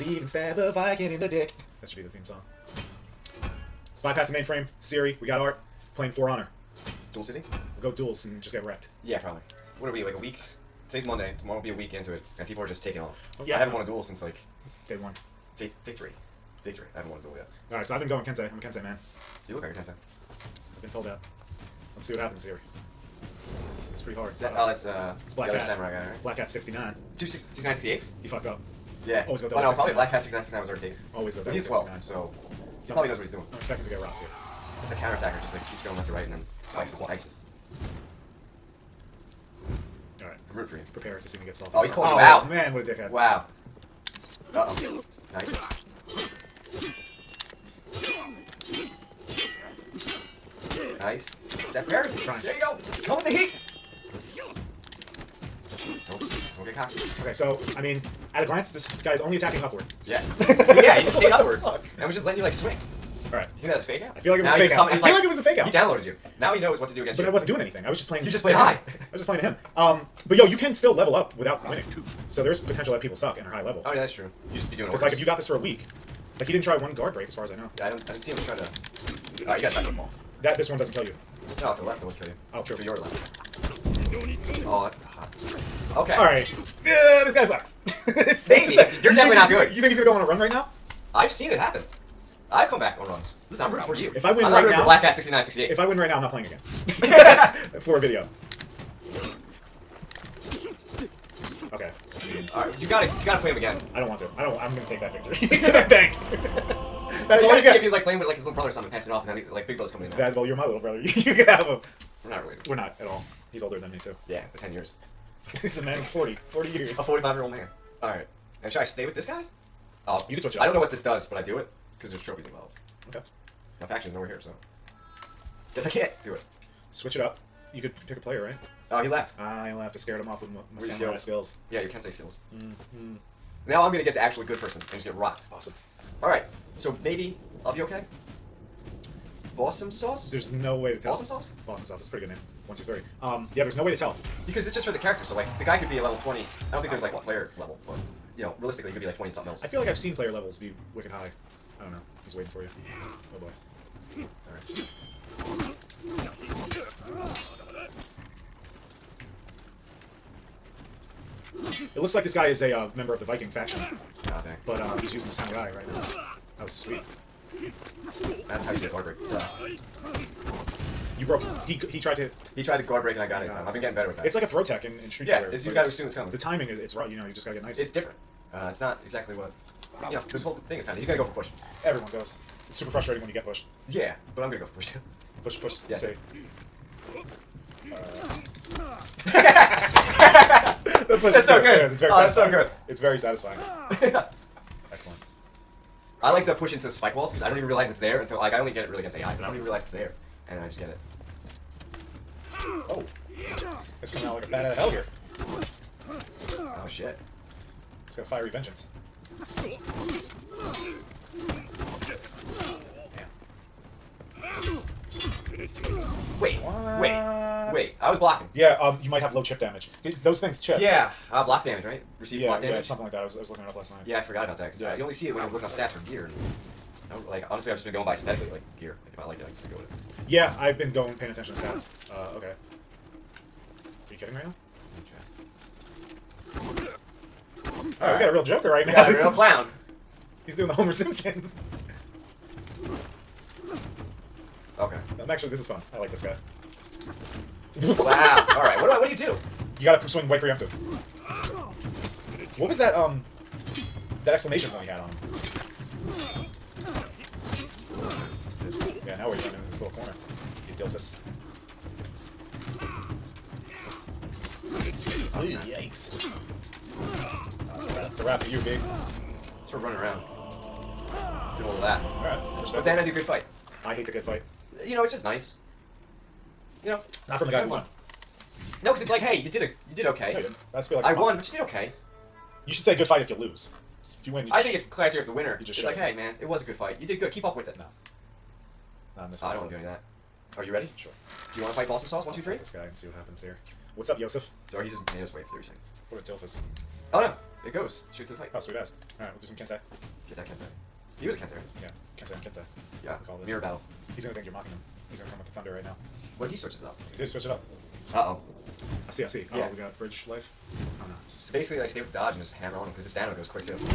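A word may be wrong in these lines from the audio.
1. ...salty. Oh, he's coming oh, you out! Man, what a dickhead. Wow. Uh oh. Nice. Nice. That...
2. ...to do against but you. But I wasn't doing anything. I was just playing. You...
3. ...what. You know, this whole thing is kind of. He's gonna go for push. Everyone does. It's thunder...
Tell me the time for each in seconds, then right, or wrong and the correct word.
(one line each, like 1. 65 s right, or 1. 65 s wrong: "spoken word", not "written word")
1. 41 s wrong: "calling", not "coming"
2. 66 s right
3. 179 s wrong: "super", not "thunder".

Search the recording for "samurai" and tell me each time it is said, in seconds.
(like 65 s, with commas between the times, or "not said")
25 s, 165 s.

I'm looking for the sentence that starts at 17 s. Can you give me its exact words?
All right, so I've been going kente.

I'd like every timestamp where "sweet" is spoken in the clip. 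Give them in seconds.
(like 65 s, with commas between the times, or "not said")
166 s, 298 s.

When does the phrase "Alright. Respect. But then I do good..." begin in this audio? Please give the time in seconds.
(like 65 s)
272 s.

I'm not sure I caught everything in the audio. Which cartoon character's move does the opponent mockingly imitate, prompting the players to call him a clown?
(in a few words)
Homer Simpson.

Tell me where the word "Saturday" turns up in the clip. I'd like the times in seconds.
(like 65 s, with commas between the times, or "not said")
not said.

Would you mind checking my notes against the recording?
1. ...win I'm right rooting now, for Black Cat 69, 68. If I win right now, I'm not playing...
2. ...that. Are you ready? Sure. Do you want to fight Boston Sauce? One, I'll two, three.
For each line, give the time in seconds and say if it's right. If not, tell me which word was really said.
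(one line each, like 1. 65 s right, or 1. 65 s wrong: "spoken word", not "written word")
1. 94 s right
2. 289 s right.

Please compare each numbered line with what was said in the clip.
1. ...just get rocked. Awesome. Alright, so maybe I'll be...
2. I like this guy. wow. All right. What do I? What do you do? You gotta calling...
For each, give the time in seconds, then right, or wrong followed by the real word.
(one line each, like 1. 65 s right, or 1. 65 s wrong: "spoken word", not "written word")
1. 134 s right
2. 245 s wrong: "swing", not "calling".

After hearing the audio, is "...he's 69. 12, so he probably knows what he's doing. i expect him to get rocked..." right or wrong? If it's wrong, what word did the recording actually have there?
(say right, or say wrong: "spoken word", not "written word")
right.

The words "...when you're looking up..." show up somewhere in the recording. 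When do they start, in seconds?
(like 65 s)
225 s.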